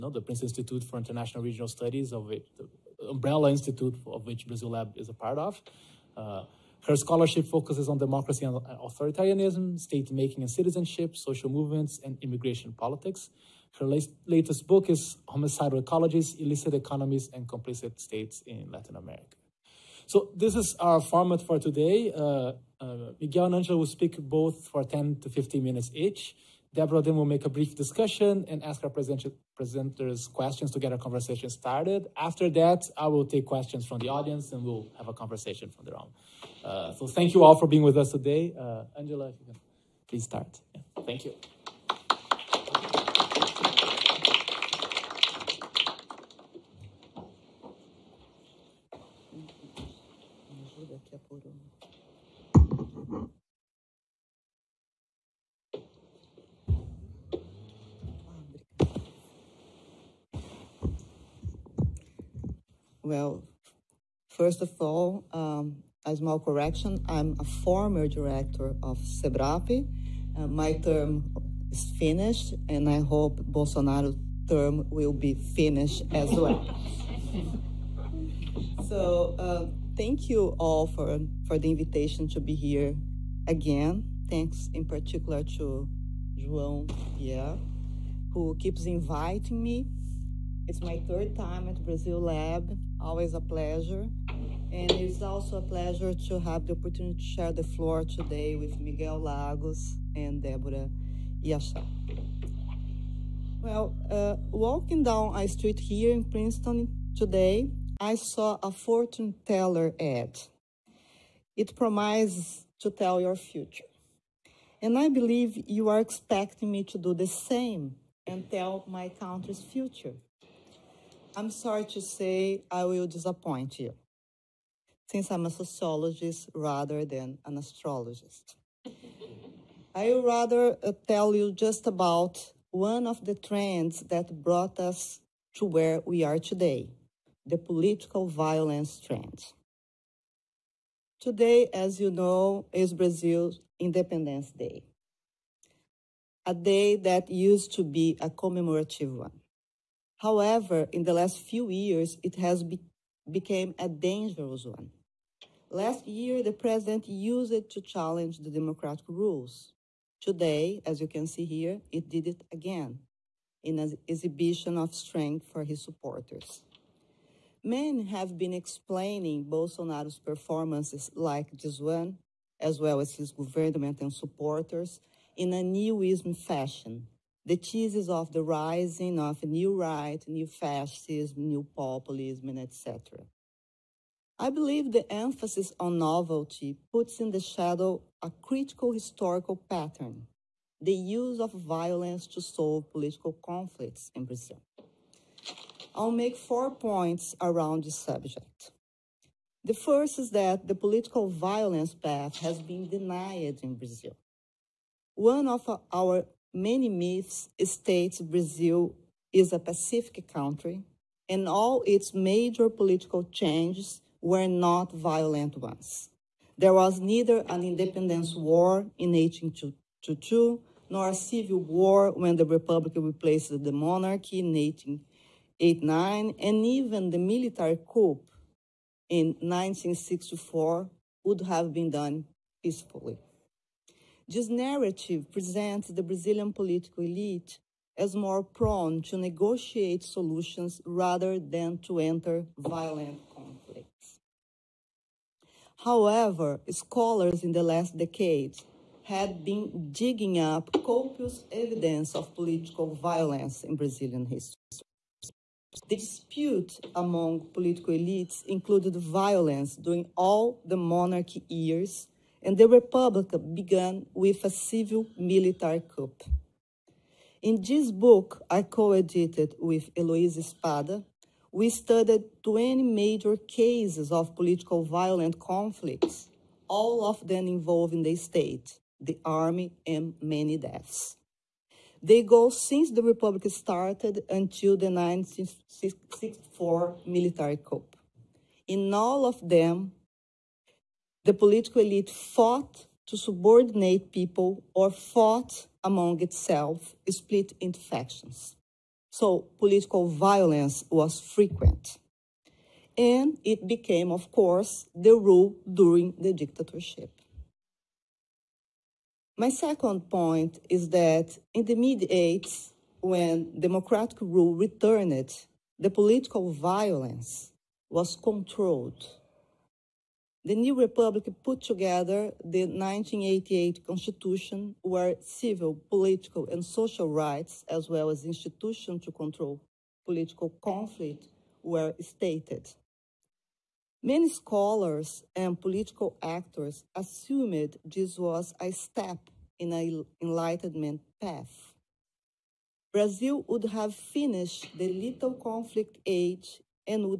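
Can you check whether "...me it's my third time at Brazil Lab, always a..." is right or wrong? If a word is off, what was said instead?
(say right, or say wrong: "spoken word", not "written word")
right.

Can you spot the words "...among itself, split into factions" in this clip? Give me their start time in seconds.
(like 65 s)
295 s.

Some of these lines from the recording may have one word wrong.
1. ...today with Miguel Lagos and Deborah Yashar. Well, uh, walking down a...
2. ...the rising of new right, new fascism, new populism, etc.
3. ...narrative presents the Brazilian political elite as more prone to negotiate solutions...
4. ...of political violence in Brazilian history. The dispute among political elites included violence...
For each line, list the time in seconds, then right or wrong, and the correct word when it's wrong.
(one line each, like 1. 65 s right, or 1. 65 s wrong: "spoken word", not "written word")
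1. 98 s right
2. 178 s right
3. 234 s right
4. 252 s right.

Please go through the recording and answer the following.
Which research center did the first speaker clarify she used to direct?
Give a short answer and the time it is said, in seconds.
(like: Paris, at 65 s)
CEBRAP, at 69 s.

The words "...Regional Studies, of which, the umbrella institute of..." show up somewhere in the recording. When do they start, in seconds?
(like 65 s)
1 s.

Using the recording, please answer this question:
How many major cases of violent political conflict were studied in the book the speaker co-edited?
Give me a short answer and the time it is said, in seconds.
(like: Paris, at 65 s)
20, at 272 s.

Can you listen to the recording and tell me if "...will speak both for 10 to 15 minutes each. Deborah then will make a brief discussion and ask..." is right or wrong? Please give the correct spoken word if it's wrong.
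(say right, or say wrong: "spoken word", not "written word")
right.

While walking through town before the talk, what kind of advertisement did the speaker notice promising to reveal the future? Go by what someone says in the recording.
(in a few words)
fortune teller ad.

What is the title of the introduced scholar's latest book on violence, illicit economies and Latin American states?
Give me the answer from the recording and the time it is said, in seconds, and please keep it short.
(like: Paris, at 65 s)
Homicidal Ecologies, at 15 s.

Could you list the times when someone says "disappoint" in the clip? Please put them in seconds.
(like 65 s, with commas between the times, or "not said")
123 s.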